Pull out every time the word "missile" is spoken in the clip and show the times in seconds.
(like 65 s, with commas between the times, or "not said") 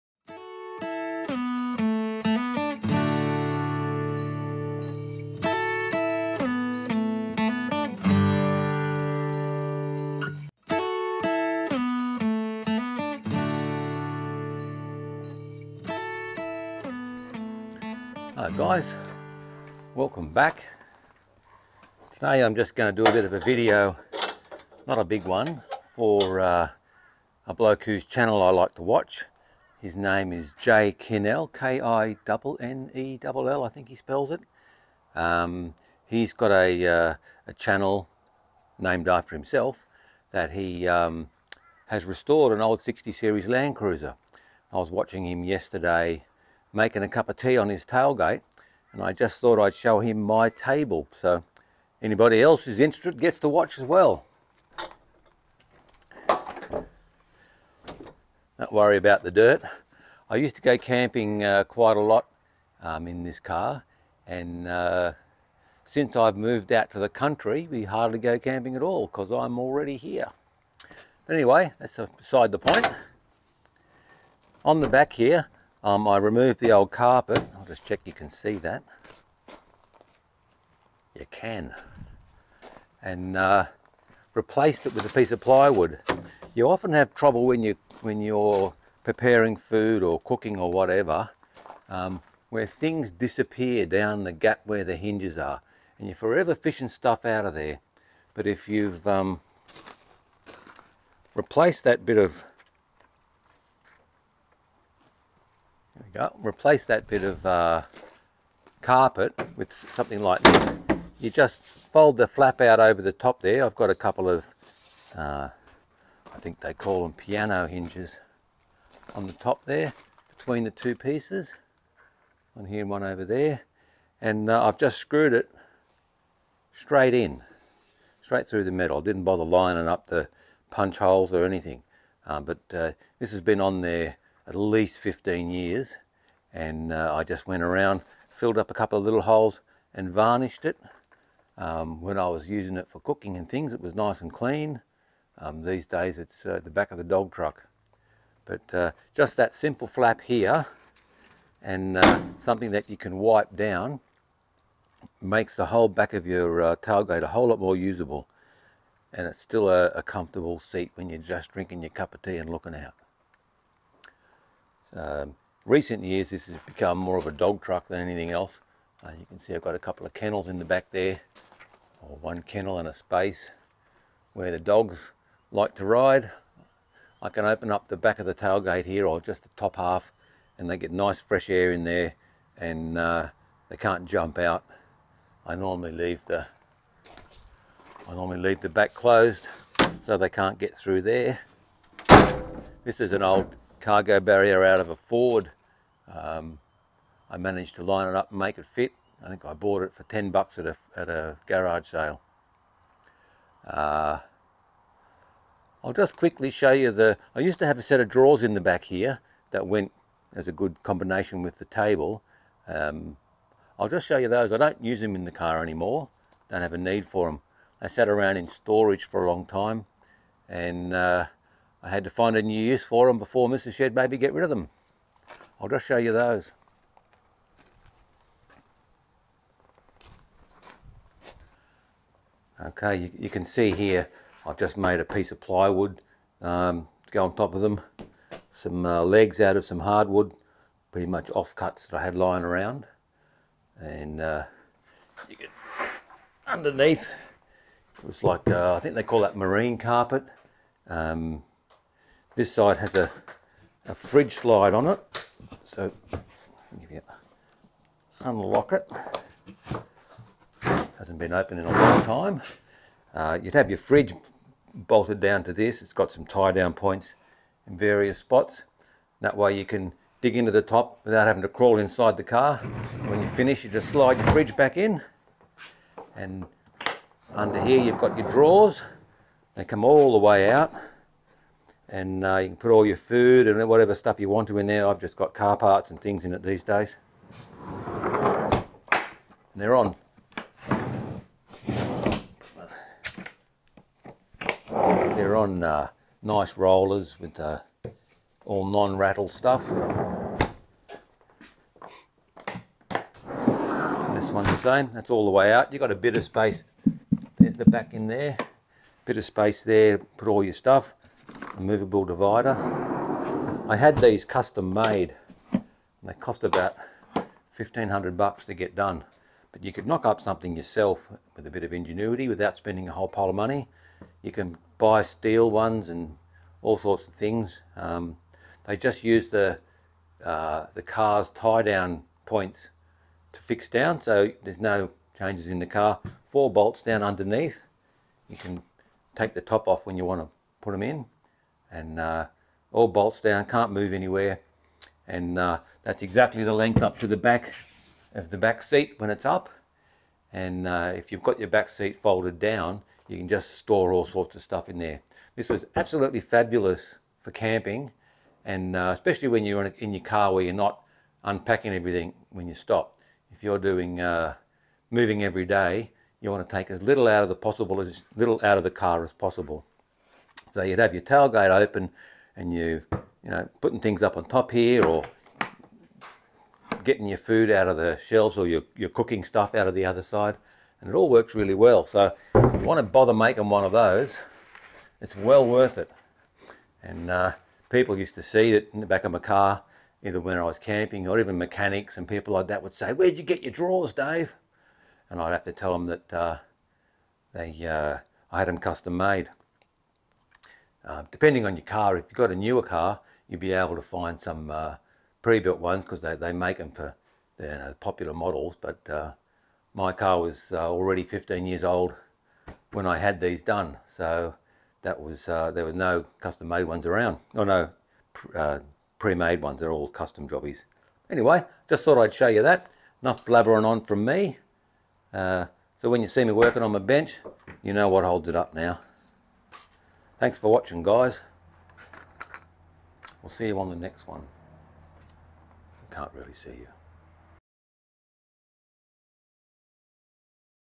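not said.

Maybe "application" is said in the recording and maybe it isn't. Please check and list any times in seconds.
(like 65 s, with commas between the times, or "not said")
not said.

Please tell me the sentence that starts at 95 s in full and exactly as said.
And you're forever fishing stuff out of there.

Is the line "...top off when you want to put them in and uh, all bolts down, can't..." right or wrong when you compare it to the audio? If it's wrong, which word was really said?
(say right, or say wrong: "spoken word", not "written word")
right.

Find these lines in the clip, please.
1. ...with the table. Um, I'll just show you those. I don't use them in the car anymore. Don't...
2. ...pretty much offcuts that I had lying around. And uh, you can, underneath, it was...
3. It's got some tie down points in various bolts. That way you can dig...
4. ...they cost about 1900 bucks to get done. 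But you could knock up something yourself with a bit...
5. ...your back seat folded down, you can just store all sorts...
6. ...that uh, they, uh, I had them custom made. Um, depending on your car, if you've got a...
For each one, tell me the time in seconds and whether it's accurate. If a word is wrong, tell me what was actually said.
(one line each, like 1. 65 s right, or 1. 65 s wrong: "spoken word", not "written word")
1. 211 s right
2. 240 s right
3. 265 s wrong: "spots", not "bolts"
4. 316 s wrong: "1500", not "1900"
5. 351 s right
6. 395 s right.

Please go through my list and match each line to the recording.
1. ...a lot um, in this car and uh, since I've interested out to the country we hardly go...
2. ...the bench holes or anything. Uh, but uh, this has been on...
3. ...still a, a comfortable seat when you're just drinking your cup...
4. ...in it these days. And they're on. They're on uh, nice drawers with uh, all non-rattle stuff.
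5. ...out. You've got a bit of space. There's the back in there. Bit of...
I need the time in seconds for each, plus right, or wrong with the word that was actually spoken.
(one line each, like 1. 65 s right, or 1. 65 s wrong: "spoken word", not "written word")
1. 61 s wrong: "moved", not "interested"
2. 130 s wrong: "punch", not "bench"
3. 159 s right
4. 286 s wrong: "rollers", not "drawers"
5. 305 s right.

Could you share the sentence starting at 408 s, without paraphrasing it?
But uh, my car was uh, already 15 years old when I had these done.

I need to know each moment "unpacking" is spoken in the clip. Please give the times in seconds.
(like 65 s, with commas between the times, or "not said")
361 s.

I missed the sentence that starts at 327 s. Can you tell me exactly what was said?
Um, they just use the, uh, the car's tie down points to fix down so there's no changes in the car.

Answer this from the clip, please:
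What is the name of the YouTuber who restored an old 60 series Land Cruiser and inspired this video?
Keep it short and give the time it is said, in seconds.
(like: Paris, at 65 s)
Jay Kinnell, at 30 s.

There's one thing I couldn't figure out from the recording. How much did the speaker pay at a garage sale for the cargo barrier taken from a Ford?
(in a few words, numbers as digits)
10 bucks.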